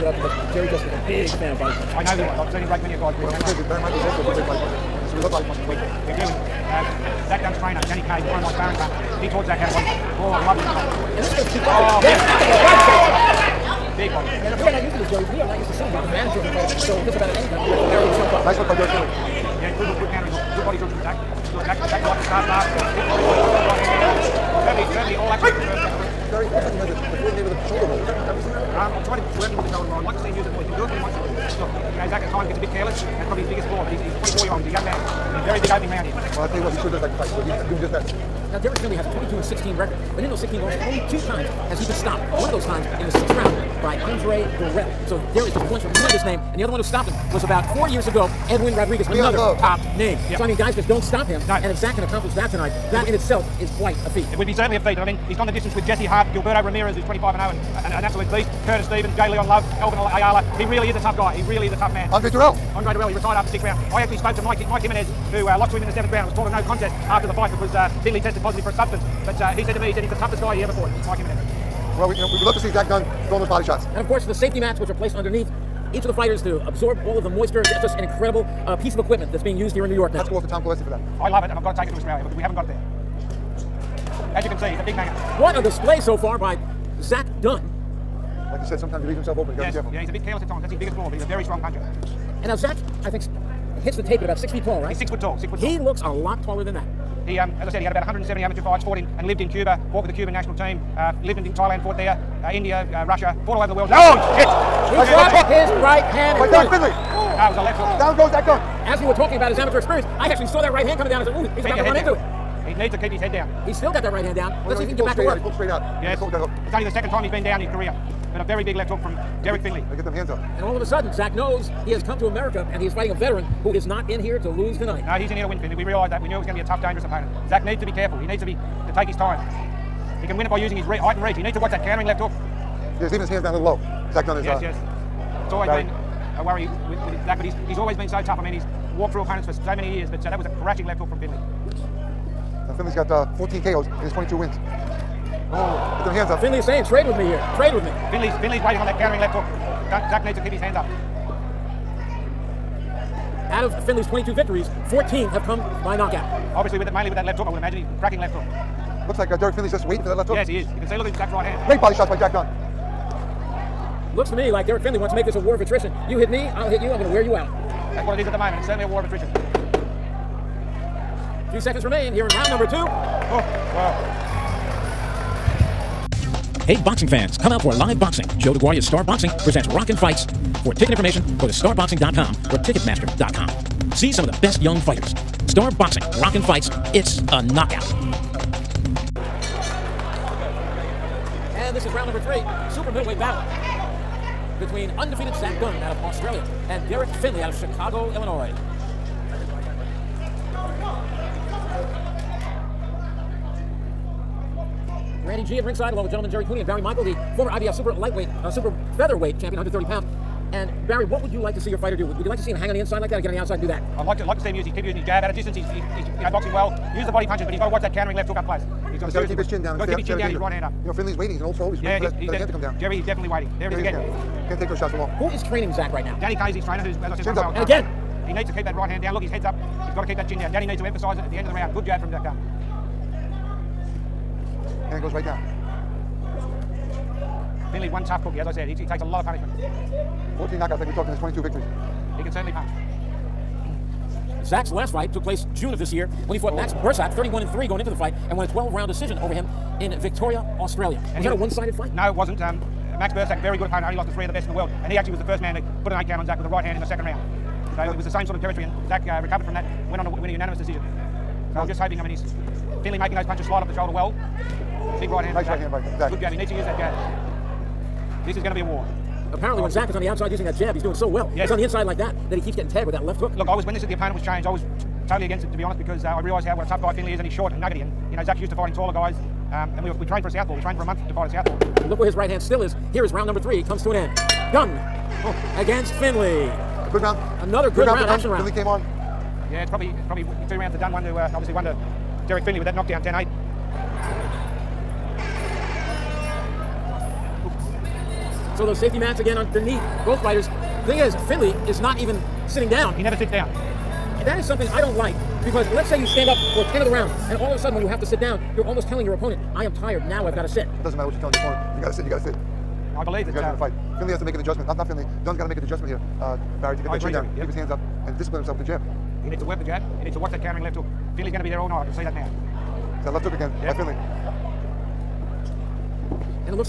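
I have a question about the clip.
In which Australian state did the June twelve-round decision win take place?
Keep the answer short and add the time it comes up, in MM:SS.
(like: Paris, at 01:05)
Victoria, at 04:10.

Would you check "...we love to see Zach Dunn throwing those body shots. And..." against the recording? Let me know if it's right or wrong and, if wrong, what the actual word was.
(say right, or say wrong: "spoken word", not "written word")
right.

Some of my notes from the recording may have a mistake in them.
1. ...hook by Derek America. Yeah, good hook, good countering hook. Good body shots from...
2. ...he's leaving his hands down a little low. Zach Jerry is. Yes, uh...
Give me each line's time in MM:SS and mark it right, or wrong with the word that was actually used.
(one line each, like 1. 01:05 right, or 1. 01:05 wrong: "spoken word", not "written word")
1. 00:18 wrong: "Findley", not "America"
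2. 02:13 wrong: "Dunn", not "Jerry".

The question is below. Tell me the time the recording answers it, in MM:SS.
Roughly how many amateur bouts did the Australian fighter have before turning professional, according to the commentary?
01:38.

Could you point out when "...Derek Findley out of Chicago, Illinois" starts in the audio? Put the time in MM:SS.
03:16.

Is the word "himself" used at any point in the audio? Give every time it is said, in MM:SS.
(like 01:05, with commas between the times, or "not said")
01:29, 05:18.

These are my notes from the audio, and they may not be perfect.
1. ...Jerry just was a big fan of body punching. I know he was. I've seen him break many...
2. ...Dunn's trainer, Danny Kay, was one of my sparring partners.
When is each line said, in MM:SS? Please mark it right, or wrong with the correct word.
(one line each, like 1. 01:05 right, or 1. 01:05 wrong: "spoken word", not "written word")
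1. 00:00 right
2. 00:07 right.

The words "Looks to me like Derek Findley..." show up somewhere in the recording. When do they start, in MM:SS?
02:44.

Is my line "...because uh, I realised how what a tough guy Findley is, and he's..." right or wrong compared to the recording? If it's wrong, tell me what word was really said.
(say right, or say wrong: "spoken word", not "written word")
right.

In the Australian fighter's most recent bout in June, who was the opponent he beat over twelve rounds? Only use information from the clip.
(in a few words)
Max Bursack.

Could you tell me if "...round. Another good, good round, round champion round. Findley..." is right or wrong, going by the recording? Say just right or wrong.
wrong.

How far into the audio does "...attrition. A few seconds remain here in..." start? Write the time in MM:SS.
02:49.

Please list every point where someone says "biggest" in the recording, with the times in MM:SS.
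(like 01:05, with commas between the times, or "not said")
00:33, 01:30.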